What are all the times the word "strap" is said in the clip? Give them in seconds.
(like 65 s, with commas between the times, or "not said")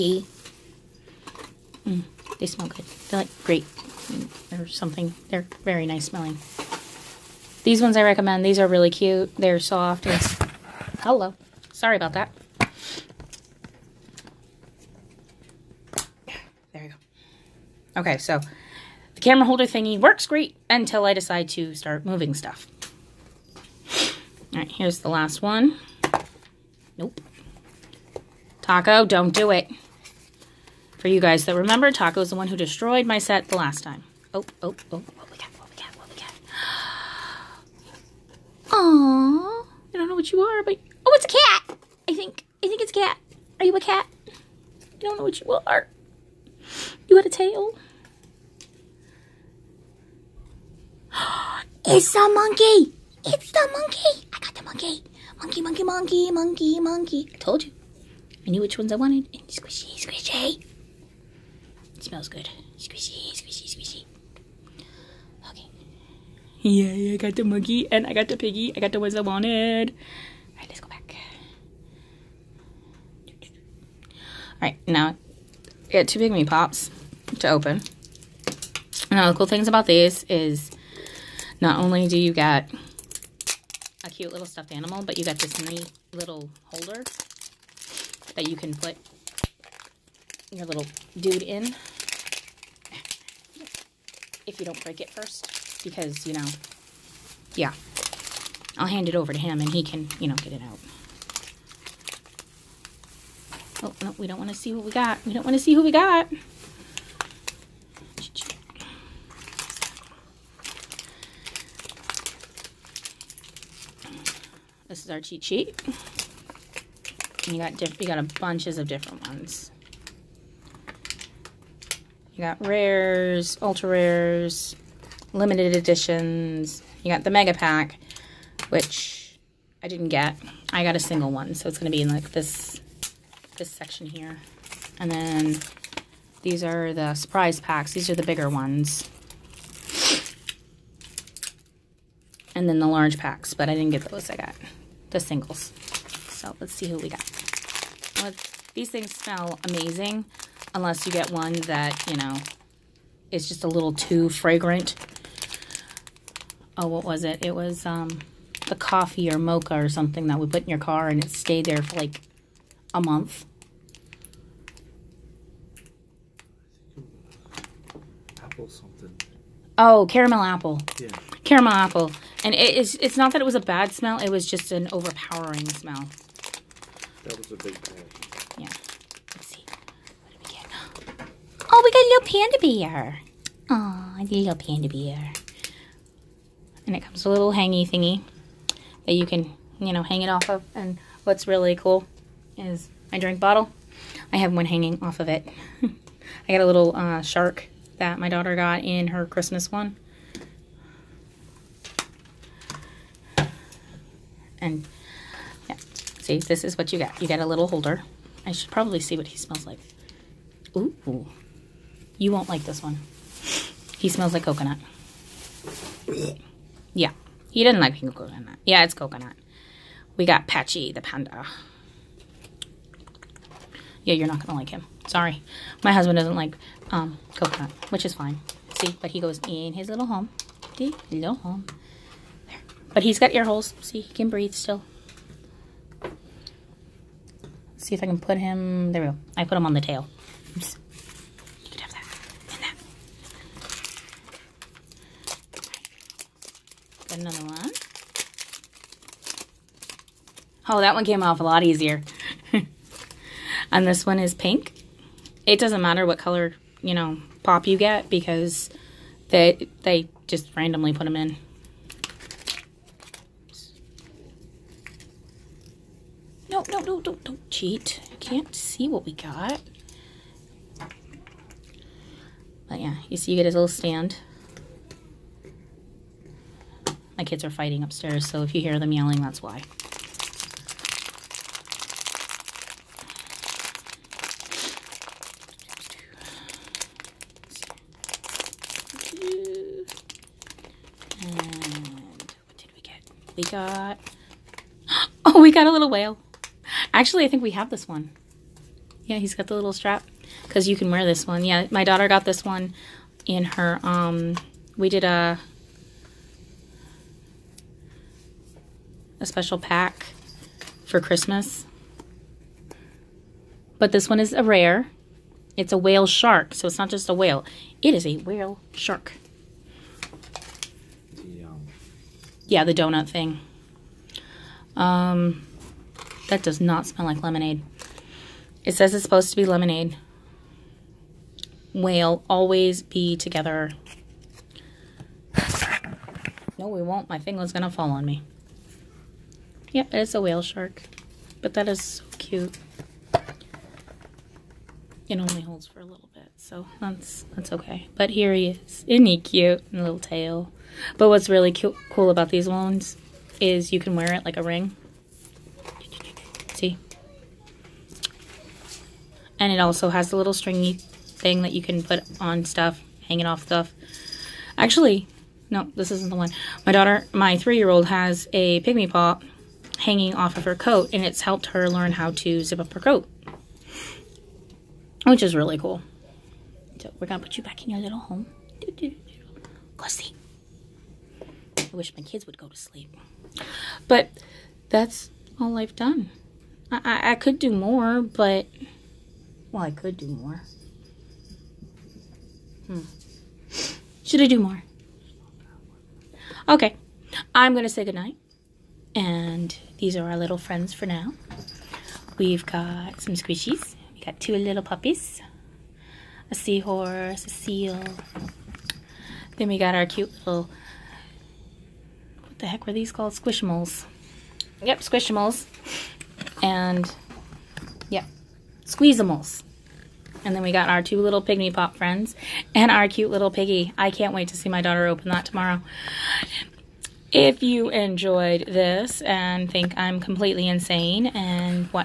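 299 s.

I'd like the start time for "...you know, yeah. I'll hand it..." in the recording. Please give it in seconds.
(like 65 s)
96 s.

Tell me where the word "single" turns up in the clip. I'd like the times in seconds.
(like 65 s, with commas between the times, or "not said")
130 s, 145 s.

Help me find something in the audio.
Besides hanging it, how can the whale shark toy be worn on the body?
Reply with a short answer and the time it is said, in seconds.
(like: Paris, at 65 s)
Like a ring, at 354 s.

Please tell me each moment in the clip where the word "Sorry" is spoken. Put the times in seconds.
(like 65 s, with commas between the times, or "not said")
11 s, 225 s.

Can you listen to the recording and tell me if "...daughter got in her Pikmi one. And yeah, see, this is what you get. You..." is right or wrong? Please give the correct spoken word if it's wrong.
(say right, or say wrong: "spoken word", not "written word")
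wrong: "Christmas", not "Pikmi".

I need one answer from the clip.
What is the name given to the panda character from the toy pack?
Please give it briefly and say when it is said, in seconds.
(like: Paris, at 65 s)
Patchy, at 220 s.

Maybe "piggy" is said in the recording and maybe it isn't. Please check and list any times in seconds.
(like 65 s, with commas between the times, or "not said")
68 s, 423 s.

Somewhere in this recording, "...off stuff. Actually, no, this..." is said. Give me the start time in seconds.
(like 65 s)
363 s.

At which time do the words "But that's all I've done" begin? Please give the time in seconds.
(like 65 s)
383 s.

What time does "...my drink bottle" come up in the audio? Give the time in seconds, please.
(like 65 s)
193 s.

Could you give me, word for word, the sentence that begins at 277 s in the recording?
My kids are fighting upstairs, so if you hear them yelling, that's why.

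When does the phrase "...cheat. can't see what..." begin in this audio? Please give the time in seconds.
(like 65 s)
267 s.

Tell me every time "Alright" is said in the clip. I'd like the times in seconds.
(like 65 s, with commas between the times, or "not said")
70 s, 74 s.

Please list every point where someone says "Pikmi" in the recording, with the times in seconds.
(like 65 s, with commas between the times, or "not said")
76 s, 368 s, 421 s.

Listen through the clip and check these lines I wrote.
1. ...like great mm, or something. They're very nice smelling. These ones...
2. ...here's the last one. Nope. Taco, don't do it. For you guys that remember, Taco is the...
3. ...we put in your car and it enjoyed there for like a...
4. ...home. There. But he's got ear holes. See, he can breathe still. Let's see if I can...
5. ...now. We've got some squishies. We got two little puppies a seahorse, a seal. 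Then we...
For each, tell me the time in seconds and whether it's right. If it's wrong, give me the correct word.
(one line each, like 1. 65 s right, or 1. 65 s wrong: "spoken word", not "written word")
1. 3 s right
2. 24 s right
3. 160 s wrong: "stayed", not "enjoyed"
4. 231 s right
5. 400 s right.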